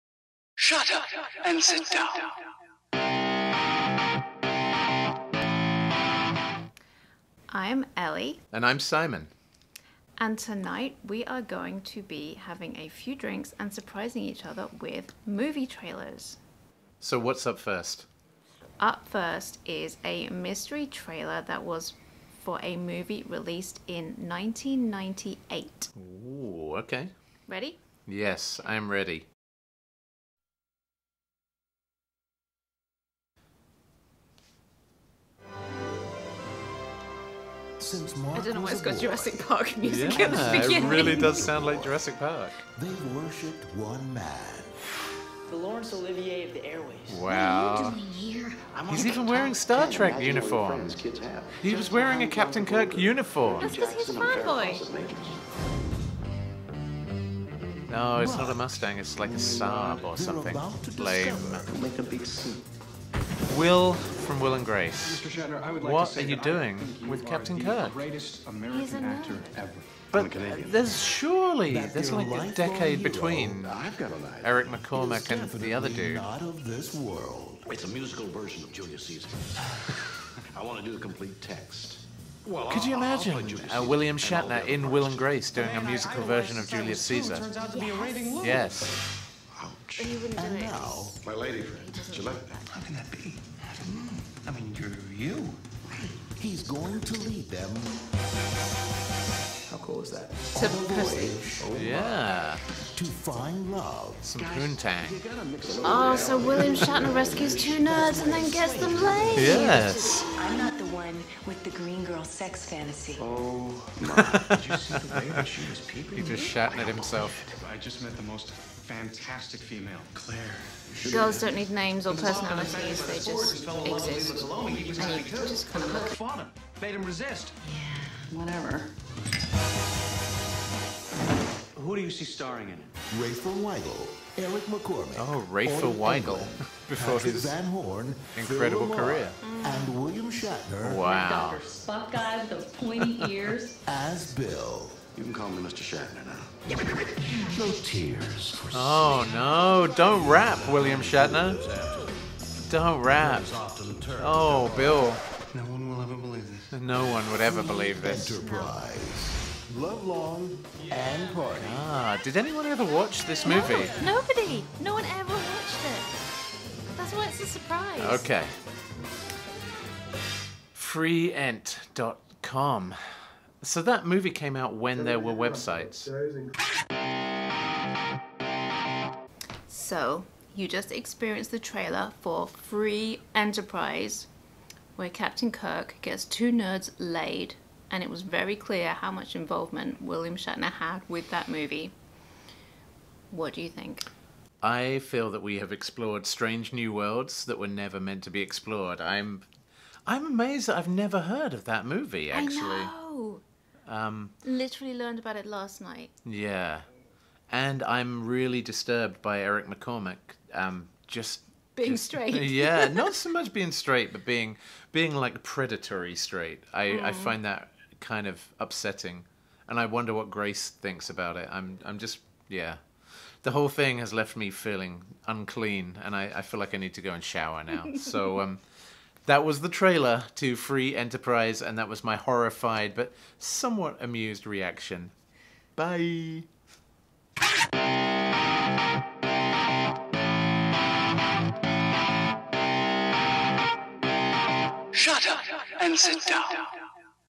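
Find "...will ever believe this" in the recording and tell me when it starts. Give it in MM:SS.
02:35.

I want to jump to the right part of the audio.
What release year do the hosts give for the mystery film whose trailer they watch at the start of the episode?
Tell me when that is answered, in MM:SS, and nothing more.
00:24.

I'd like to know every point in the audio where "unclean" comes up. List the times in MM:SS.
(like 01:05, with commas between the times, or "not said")
03:45.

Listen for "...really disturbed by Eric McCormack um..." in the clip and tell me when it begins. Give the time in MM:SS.
03:28.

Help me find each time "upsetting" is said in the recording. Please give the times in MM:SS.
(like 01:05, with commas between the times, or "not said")
03:38.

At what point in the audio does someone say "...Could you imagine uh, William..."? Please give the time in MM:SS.
01:22.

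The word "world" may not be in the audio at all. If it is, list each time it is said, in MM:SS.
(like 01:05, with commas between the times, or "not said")
01:16, 03:16.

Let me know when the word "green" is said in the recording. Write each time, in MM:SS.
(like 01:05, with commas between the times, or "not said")
01:51.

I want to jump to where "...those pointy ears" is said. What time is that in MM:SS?
02:22.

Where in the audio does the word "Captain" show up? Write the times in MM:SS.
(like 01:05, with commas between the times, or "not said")
00:52, 01:07, 03:05.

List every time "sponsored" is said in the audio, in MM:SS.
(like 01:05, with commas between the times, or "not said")
not said.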